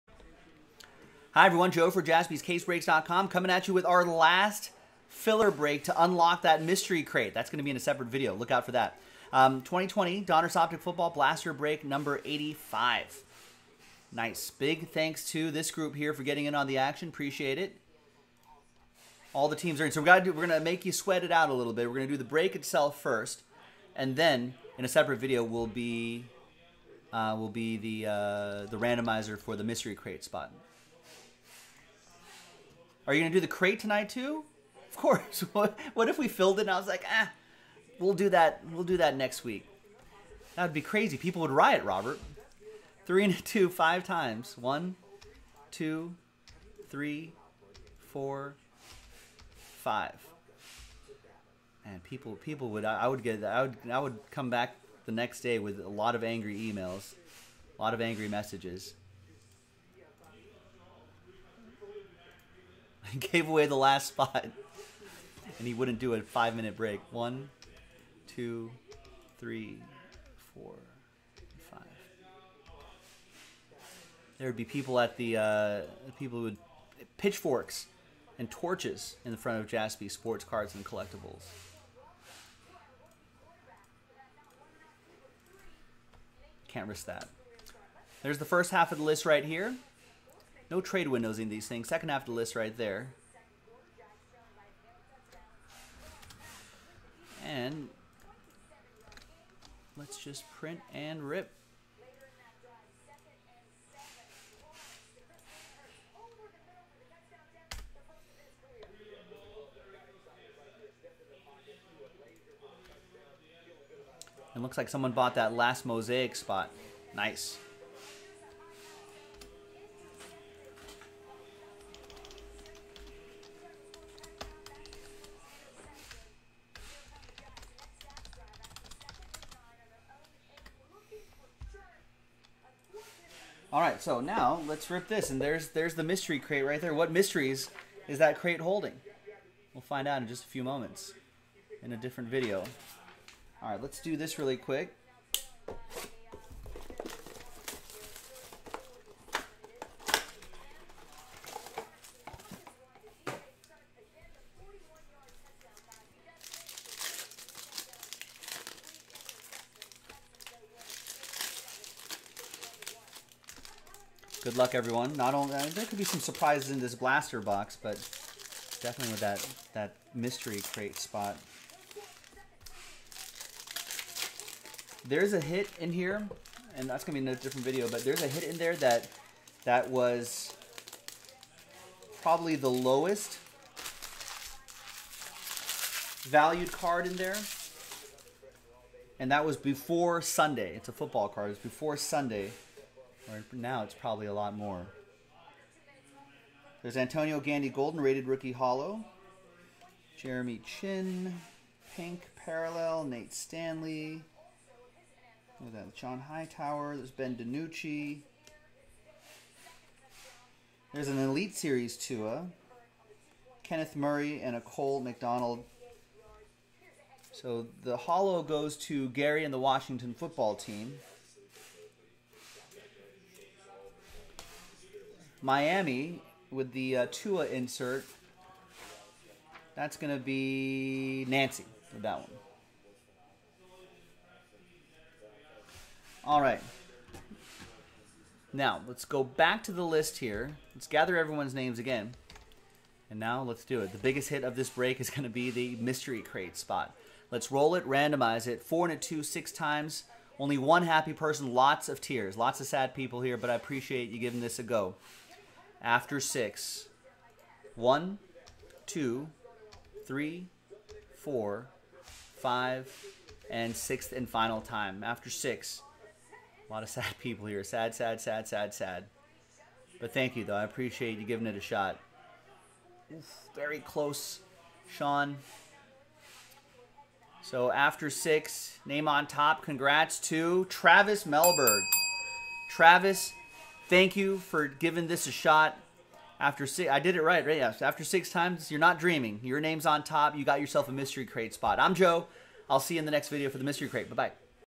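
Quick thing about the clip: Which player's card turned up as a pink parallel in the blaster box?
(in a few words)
Jeremy Chinn.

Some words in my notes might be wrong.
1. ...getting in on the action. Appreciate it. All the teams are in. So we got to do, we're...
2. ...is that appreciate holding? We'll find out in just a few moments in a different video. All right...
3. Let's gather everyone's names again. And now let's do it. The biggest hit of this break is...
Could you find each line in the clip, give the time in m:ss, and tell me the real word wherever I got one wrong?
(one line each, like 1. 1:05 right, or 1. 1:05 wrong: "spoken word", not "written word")
1. 0:16 right
2. 2:18 wrong: "crate", not "appreciate"
3. 4:00 right.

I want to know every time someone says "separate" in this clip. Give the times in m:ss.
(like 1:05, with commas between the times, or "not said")
0:07, 0:24.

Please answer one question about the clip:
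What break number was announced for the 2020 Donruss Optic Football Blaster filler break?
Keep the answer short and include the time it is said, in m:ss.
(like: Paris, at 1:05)
85, at 0:11.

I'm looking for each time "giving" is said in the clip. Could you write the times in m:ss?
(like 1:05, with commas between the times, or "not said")
4:14, 4:31, 4:44.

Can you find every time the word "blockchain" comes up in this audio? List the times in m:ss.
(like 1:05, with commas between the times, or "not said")
not said.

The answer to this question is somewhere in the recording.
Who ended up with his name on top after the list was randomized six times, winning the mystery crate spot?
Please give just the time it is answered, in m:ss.
4:40.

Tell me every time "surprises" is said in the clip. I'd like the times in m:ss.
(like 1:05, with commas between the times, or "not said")
2:46.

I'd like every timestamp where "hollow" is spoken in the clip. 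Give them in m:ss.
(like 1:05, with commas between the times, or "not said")
3:18, 3:37.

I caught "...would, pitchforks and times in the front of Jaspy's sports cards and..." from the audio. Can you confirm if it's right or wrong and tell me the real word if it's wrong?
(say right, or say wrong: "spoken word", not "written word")
wrong: "torches", not "times".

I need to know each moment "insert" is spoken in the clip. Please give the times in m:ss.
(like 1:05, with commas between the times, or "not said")
3:47.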